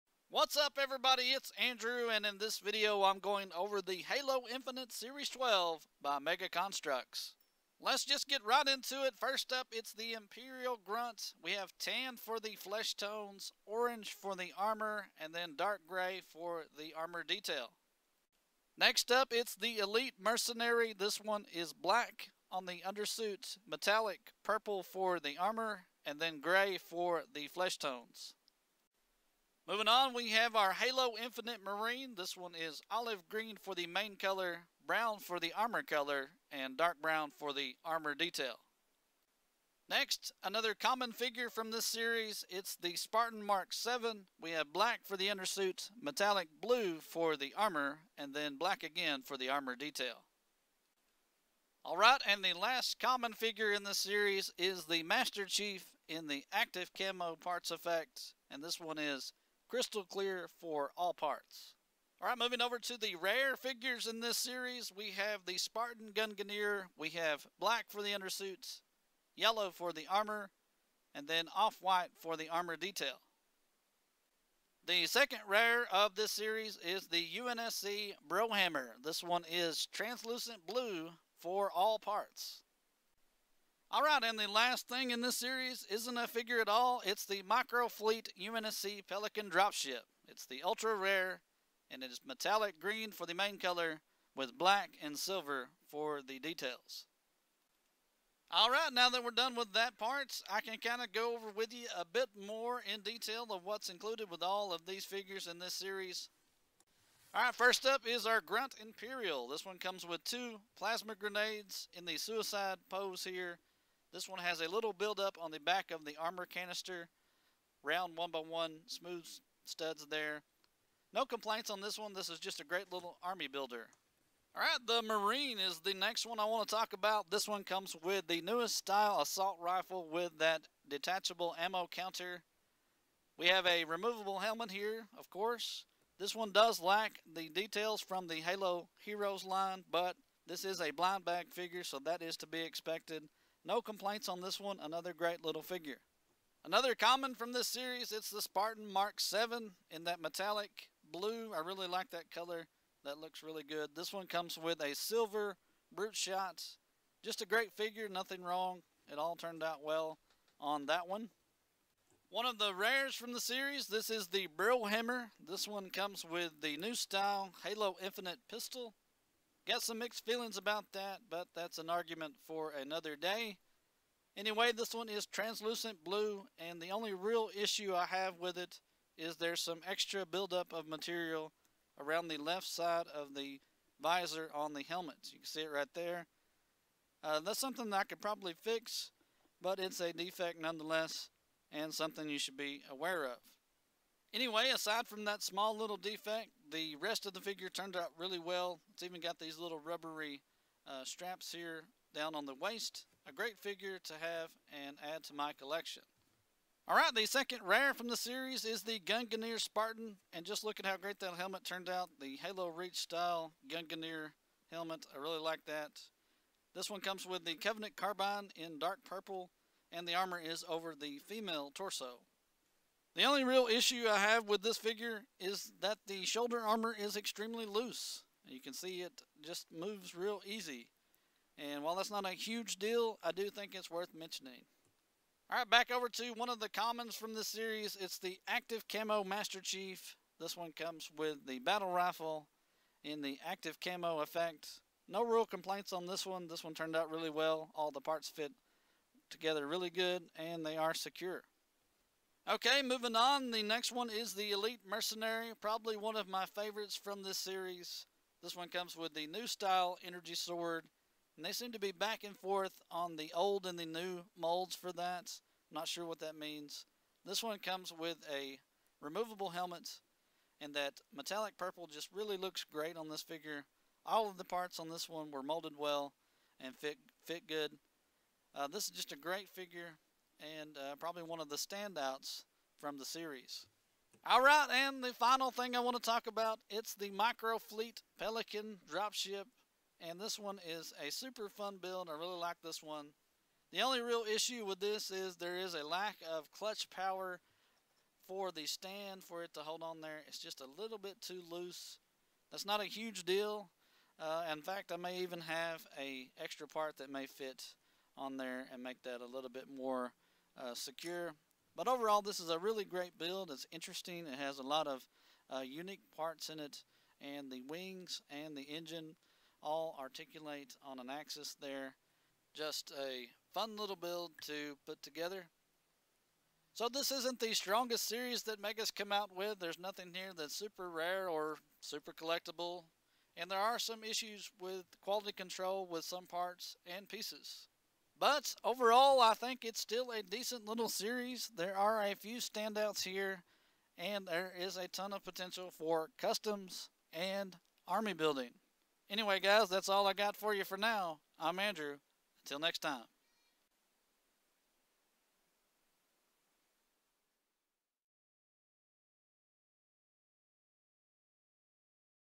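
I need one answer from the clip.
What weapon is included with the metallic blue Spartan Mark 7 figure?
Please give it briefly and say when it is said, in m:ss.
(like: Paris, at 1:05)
Silver brute shot, at 2:34.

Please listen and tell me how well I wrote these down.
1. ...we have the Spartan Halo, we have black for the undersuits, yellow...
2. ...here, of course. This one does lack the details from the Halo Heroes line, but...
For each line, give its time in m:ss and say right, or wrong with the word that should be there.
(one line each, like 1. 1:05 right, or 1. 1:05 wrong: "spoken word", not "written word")
1. 1:04 wrong: "Gungnir", not "Halo"
2. 2:14 right.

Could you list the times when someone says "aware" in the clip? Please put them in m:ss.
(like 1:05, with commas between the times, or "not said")
3:12.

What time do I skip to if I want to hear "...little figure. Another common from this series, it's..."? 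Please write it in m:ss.
2:25.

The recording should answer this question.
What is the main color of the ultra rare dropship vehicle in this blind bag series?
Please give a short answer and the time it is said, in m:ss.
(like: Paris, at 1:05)
Metallic green, at 1:32.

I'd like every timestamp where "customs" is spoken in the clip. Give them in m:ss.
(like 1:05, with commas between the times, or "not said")
5:46.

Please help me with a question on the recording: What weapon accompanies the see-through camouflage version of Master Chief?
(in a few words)
Battle rifle.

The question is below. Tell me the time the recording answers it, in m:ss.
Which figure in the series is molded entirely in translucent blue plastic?
1:17.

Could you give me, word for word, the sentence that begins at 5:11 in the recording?
But overall, this is a really great build.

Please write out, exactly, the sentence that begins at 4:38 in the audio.
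Uh, this is just a great figure and uh, probably one of the standouts from the series.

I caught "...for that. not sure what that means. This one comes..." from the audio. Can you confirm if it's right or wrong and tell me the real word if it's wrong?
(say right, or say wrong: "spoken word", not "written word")
right.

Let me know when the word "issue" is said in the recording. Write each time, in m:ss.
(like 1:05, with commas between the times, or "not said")
2:57, 3:43, 4:54, 5:34.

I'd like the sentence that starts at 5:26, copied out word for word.
So this isn't the strongest series that Mega's come out with.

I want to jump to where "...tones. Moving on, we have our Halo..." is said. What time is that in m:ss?
0:27.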